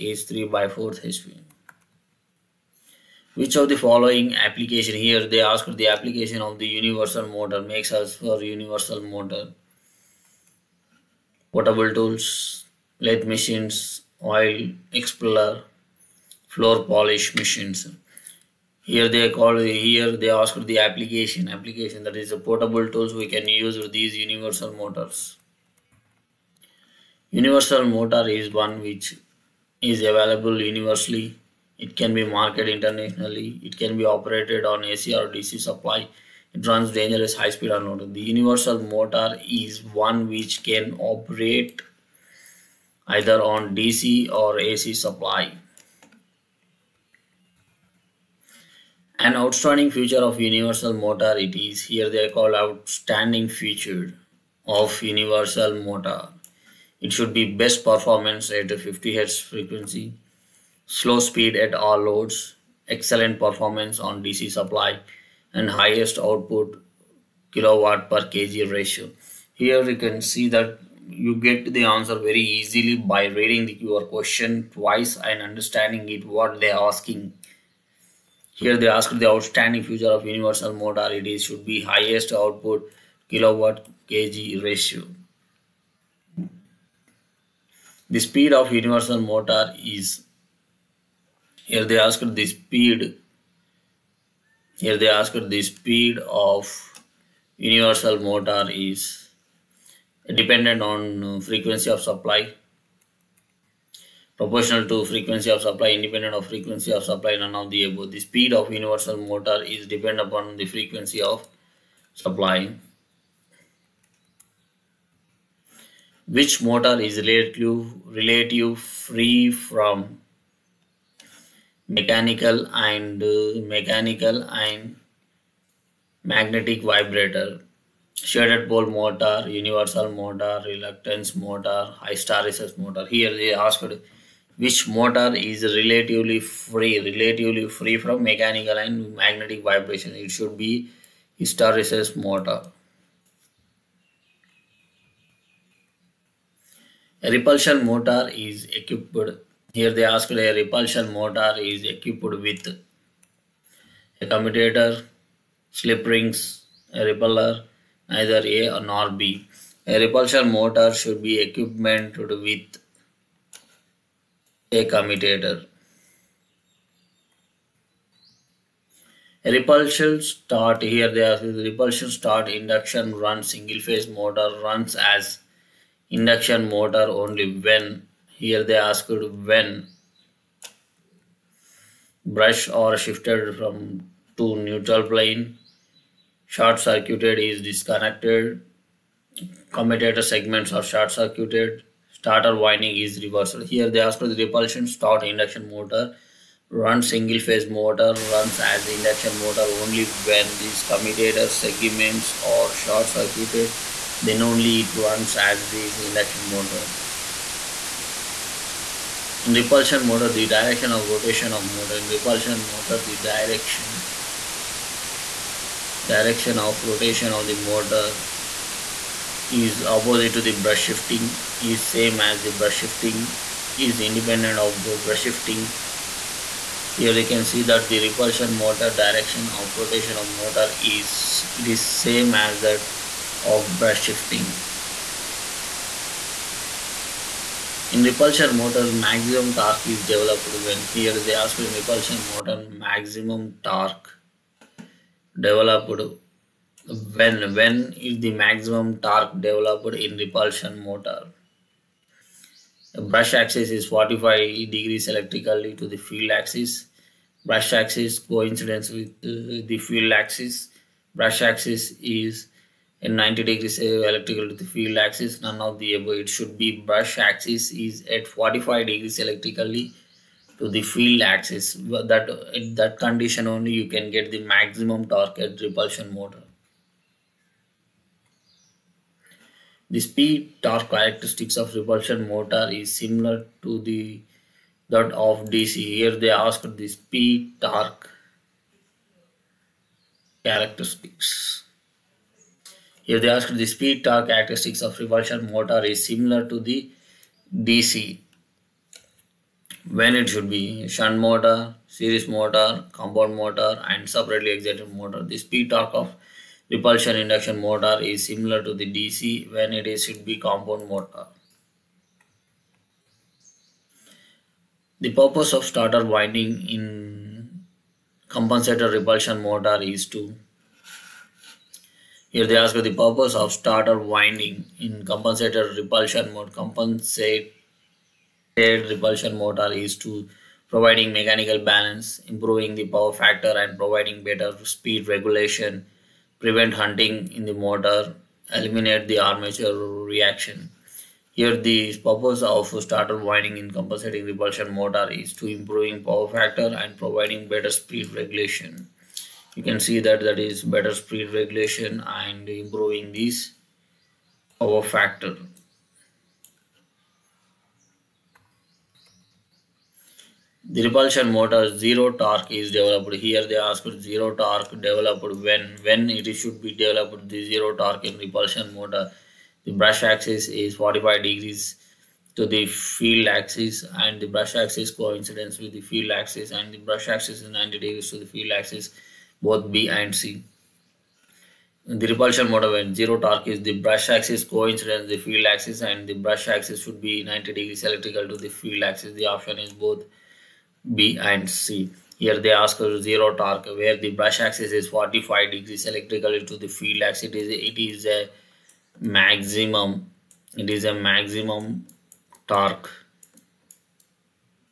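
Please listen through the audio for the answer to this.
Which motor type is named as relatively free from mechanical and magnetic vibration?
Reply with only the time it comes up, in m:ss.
2:20.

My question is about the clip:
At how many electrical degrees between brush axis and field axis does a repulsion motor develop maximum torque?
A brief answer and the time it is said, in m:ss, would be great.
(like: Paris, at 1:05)
45 degrees, at 4:28.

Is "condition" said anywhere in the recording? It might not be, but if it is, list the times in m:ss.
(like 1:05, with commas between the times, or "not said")
4:32.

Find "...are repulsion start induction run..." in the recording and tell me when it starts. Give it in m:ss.
2:51.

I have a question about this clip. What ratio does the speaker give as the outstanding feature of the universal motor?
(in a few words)
Highest output kilowatt per kg.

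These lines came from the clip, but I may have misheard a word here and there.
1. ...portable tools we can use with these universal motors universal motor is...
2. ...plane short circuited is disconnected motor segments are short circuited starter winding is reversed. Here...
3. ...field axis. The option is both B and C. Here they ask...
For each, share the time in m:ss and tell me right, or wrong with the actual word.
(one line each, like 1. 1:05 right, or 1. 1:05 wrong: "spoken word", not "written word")
1. 0:22 right
2. 3:05 wrong: "commutator", not "motor"
3. 6:28 right.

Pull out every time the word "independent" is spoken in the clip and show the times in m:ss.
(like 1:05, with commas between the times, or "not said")
1:45, 3:44.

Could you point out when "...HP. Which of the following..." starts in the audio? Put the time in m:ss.
0:01.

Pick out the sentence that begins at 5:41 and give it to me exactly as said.
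Here the purpose of starter winding in compensating repulsion motor is to improving power factor and providing better speed regulation.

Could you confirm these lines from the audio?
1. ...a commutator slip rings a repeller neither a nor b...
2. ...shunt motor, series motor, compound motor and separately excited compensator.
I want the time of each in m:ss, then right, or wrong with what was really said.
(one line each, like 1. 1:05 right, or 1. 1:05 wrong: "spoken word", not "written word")
1. 2:34 right
2. 5:00 wrong: "motor", not "compensator".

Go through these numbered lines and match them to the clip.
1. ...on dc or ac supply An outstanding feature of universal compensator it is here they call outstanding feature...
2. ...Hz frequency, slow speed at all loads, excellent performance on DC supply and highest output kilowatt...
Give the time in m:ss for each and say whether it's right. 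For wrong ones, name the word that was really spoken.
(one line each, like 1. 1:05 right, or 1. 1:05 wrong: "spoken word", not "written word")
1. 0:43 wrong: "motor", not "compensator"
2. 0:59 right.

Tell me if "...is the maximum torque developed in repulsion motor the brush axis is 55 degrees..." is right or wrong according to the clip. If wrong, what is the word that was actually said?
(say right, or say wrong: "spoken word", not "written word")
wrong: "45", not "55".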